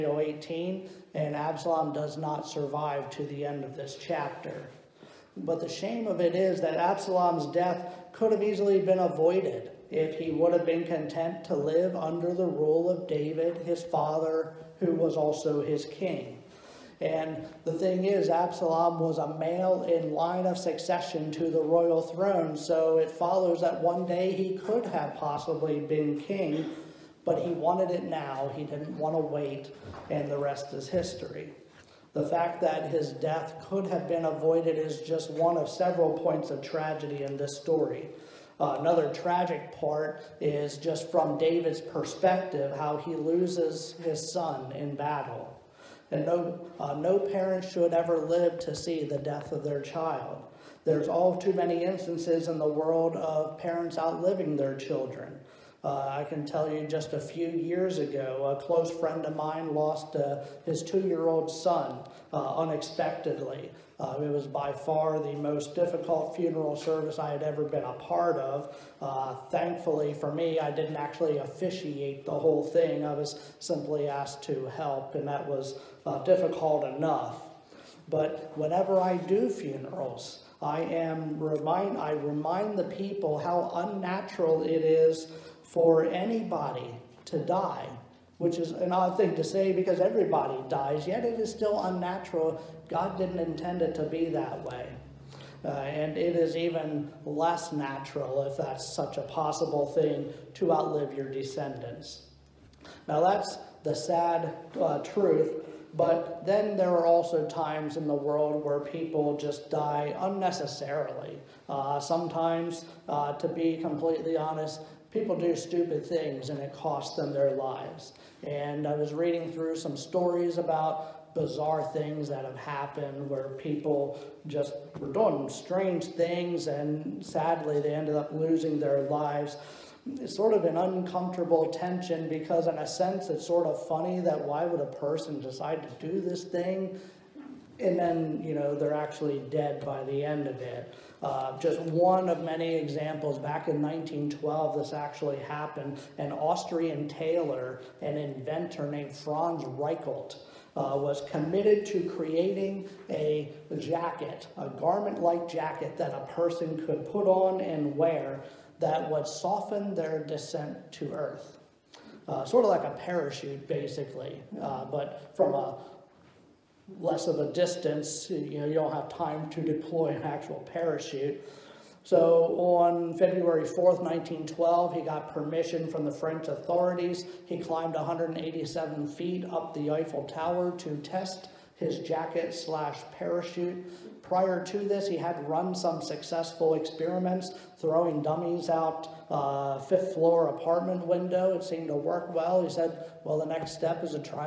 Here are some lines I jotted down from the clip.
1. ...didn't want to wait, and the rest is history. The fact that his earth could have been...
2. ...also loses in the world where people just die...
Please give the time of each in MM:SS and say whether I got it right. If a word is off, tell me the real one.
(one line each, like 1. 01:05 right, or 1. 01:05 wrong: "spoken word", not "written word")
1. 00:28 wrong: "death", not "earth"
2. 01:47 wrong: "times", not "loses".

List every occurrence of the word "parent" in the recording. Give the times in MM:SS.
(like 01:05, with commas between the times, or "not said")
00:47, 00:53.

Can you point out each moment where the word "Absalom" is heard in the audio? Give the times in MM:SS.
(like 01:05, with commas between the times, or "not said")
00:01, 00:06, 00:18.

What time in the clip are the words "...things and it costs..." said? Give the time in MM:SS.
01:56.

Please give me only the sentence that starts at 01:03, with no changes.
Uh, it was by far the most difficult funeral service I had ever been a part of.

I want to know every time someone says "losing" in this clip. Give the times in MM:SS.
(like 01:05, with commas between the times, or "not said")
02:08.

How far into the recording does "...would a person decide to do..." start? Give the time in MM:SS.
02:14.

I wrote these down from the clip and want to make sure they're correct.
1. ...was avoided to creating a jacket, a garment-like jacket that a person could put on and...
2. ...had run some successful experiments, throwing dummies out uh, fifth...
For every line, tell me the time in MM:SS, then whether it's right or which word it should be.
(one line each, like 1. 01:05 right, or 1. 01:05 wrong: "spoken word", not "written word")
1. 02:30 wrong: "committed", not "avoided"
2. 03:05 right.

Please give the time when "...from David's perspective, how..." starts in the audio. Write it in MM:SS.
00:41.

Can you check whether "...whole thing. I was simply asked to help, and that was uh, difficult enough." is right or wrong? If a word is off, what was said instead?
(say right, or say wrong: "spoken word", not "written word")
right.